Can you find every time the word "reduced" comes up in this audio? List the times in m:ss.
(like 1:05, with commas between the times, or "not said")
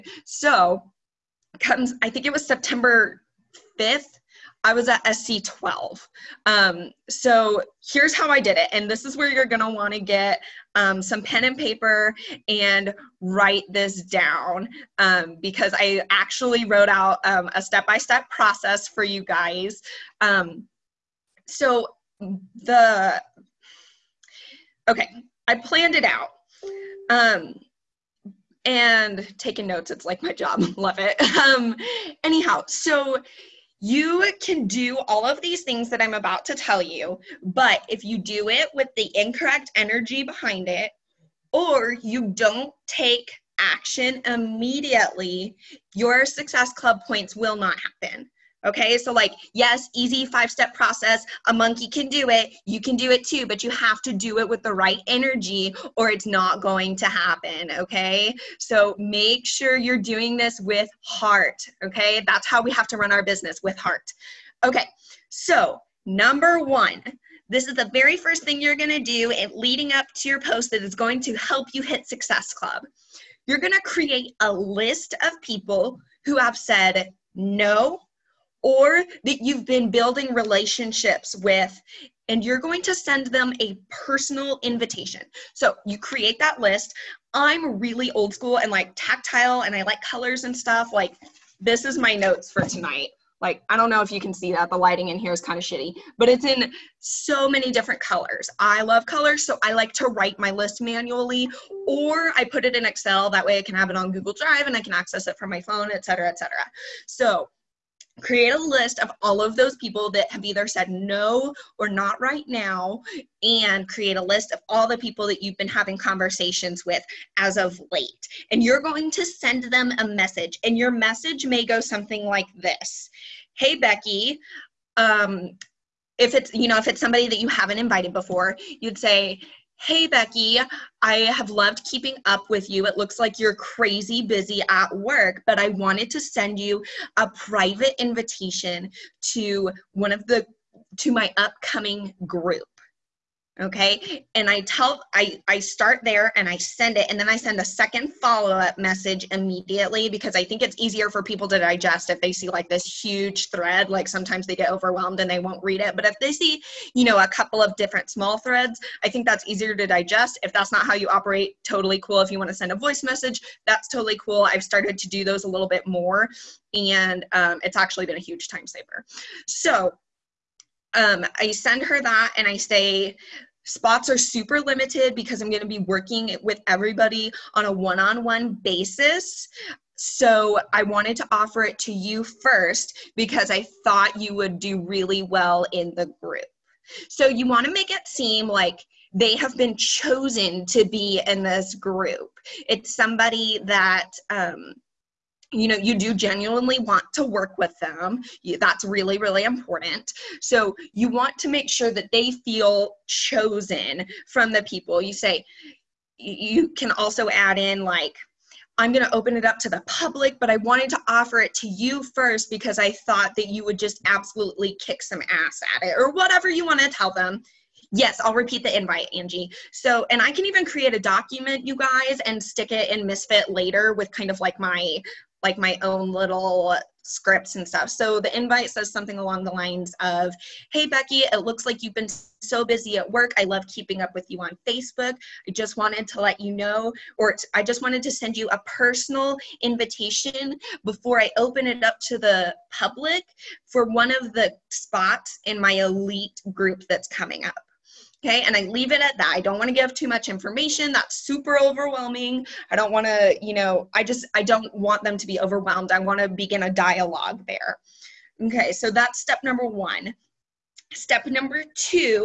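not said.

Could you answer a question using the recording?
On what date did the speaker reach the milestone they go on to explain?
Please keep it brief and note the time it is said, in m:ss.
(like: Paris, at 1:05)
September 5th, at 0:02.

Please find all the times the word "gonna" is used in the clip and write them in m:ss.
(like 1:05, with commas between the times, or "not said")
1:08, 1:13.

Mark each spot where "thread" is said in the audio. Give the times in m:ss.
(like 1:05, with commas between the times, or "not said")
2:33, 2:38.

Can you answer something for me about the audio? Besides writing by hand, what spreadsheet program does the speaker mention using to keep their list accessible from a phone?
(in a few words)
Excel.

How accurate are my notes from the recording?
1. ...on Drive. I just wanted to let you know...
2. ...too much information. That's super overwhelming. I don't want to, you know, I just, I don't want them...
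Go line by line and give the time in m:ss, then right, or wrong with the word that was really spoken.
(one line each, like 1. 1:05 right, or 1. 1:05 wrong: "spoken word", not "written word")
1. 3:54 wrong: "Facebook", not "Drive"
2. 4:09 right.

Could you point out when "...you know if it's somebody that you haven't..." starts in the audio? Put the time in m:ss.
2:06.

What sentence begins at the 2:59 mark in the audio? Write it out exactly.
So I wanted to offer it to you first because I thought you would do really well in the group.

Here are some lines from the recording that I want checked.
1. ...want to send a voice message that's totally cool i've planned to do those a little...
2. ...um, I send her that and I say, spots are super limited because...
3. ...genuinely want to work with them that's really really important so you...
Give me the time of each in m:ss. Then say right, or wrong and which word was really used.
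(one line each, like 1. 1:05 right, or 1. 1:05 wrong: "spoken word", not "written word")
1. 2:42 wrong: "started", not "planned"
2. 2:50 right
3. 3:16 right.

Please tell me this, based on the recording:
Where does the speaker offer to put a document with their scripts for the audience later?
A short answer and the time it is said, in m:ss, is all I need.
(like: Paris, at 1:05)
Misfit, at 3:43.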